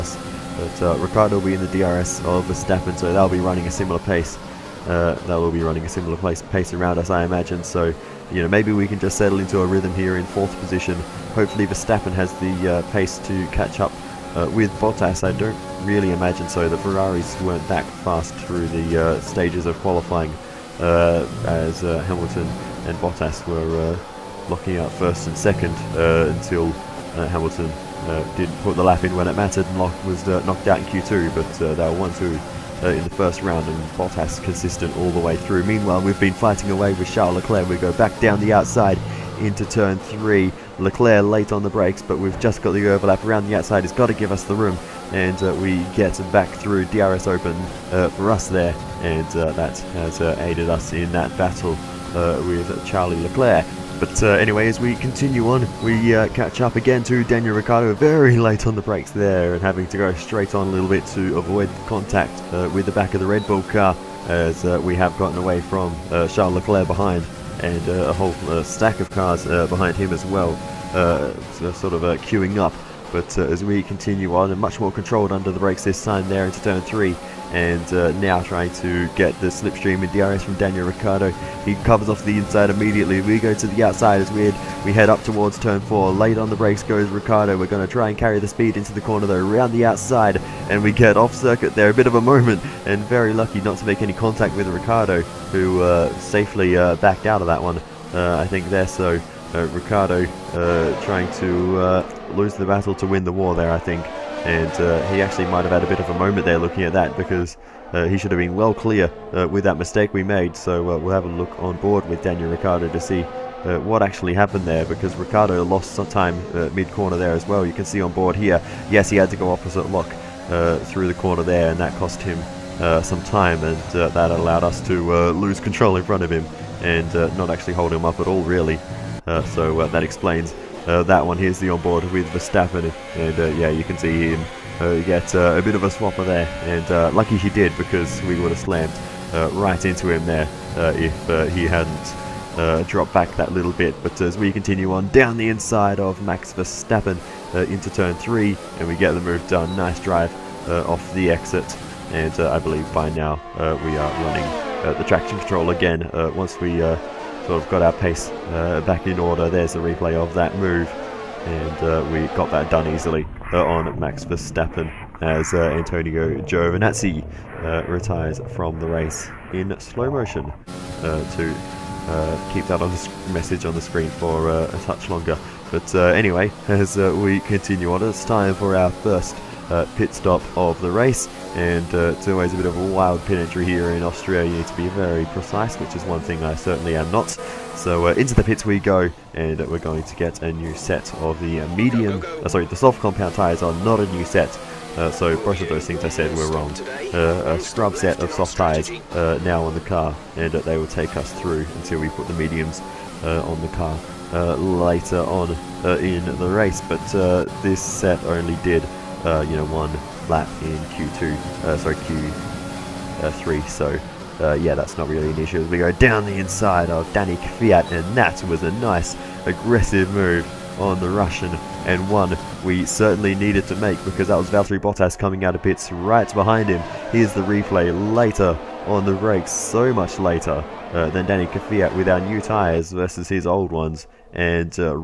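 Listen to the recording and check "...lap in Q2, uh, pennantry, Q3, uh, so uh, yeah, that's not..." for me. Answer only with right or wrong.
wrong.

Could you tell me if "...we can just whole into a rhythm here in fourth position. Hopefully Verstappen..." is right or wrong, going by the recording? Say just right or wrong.
wrong.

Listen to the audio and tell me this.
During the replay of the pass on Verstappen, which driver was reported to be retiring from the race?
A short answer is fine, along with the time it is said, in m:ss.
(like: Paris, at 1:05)
Antonio Giovinazzi, at 2:45.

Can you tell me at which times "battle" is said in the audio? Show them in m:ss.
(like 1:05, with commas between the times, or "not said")
0:51, 1:42.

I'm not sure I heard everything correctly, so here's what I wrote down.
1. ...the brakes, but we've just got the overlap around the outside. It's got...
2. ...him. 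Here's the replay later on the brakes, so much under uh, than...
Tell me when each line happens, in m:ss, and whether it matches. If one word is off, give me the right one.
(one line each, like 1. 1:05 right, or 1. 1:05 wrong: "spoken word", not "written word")
1. 0:41 right
2. 3:46 wrong: "later", not "under".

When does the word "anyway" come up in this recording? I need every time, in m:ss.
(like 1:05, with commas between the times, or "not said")
0:54, 2:55.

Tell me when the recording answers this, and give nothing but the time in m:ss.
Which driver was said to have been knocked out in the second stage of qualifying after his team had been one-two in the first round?
0:29.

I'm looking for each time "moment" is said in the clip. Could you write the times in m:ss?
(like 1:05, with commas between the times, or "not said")
1:32, 1:46.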